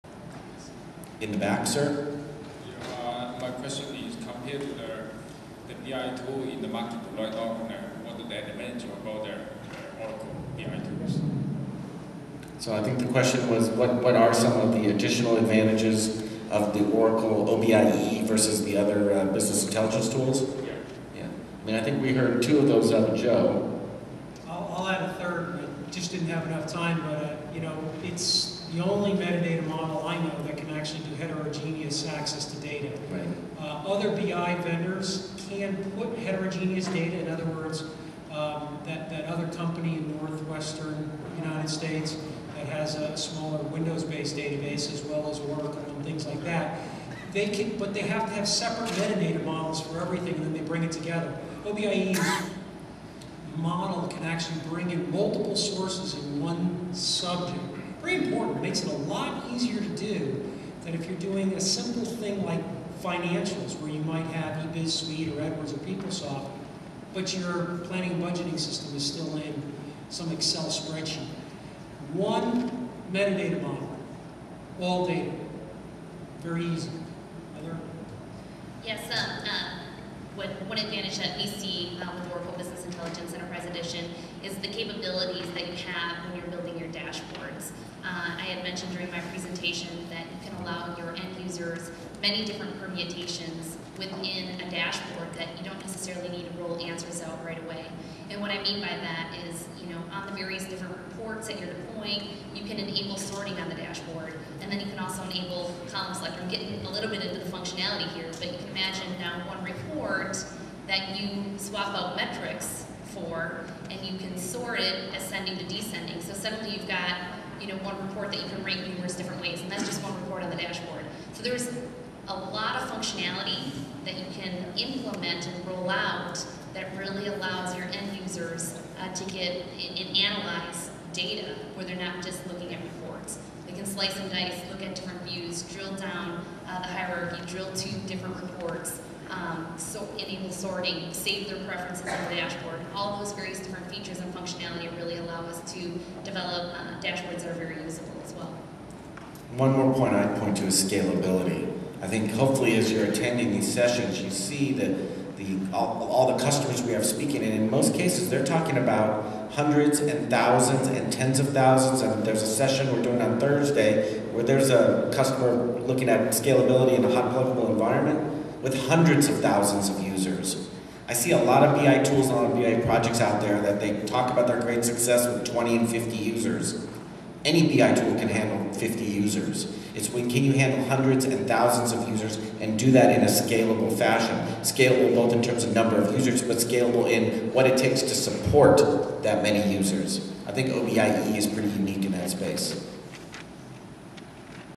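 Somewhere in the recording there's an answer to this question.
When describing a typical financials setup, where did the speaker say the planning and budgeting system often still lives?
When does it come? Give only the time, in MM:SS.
01:10.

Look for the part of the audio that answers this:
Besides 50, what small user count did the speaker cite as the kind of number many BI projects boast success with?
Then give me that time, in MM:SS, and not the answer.
02:55.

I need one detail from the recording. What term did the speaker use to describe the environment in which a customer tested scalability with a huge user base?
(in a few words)
hot pluggable.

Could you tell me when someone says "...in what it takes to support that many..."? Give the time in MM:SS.
03:07.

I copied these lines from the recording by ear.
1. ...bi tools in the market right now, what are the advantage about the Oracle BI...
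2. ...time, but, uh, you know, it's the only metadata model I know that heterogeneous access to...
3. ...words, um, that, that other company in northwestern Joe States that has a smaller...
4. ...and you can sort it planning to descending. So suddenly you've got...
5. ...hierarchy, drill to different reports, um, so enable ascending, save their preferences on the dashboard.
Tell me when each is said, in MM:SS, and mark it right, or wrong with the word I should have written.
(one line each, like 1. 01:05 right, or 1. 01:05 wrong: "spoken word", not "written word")
1. 00:05 right
2. 00:26 right
3. 00:37 wrong: "United", not "Joe"
4. 01:53 wrong: "ascending", not "planning"
5. 02:16 wrong: "sorting", not "ascending".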